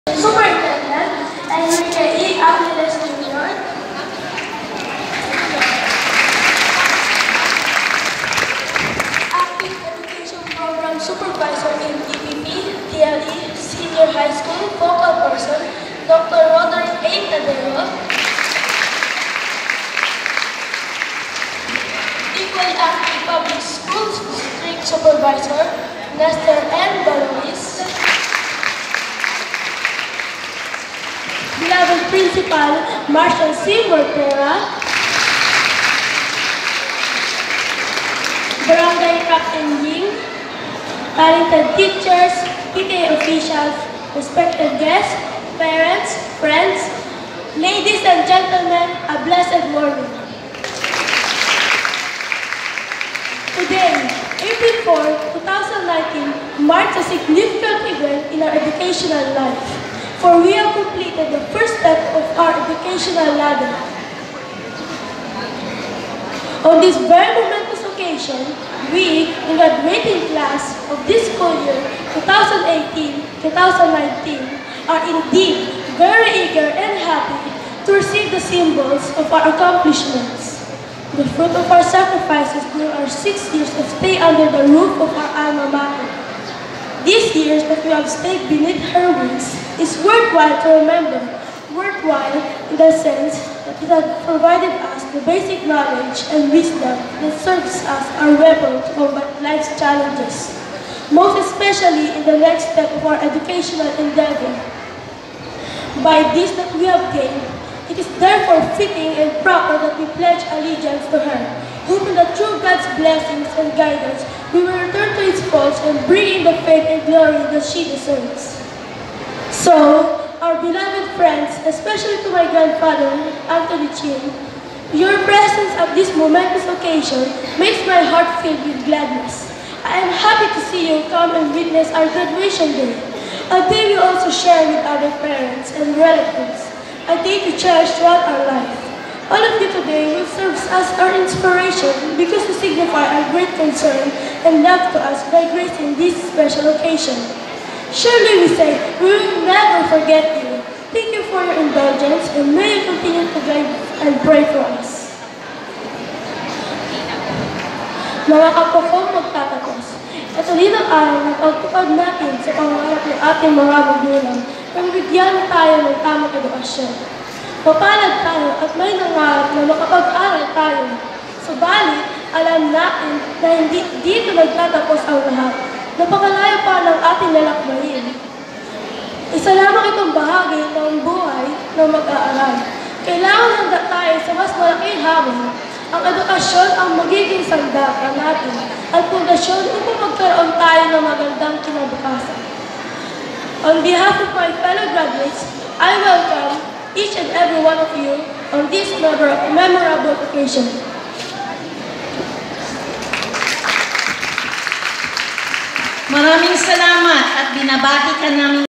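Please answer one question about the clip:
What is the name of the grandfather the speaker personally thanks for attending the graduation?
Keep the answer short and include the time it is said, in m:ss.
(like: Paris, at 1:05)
Anthony Chin, at 2:03.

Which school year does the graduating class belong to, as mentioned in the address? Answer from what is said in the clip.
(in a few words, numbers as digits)
2018-2019.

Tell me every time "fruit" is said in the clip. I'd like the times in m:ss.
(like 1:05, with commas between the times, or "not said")
1:21.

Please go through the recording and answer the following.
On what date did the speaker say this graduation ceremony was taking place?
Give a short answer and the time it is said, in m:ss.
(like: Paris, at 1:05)
April 4, 2019, at 0:54.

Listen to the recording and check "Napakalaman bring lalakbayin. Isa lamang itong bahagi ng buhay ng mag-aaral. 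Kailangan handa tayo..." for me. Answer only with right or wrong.
wrong.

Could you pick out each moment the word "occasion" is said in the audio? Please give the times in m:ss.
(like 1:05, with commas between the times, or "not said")
1:07, 2:06, 2:26, 3:20.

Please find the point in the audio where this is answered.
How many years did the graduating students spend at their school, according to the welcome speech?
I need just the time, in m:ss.
1:23.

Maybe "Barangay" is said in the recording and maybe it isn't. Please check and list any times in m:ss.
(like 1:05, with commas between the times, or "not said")
0:38.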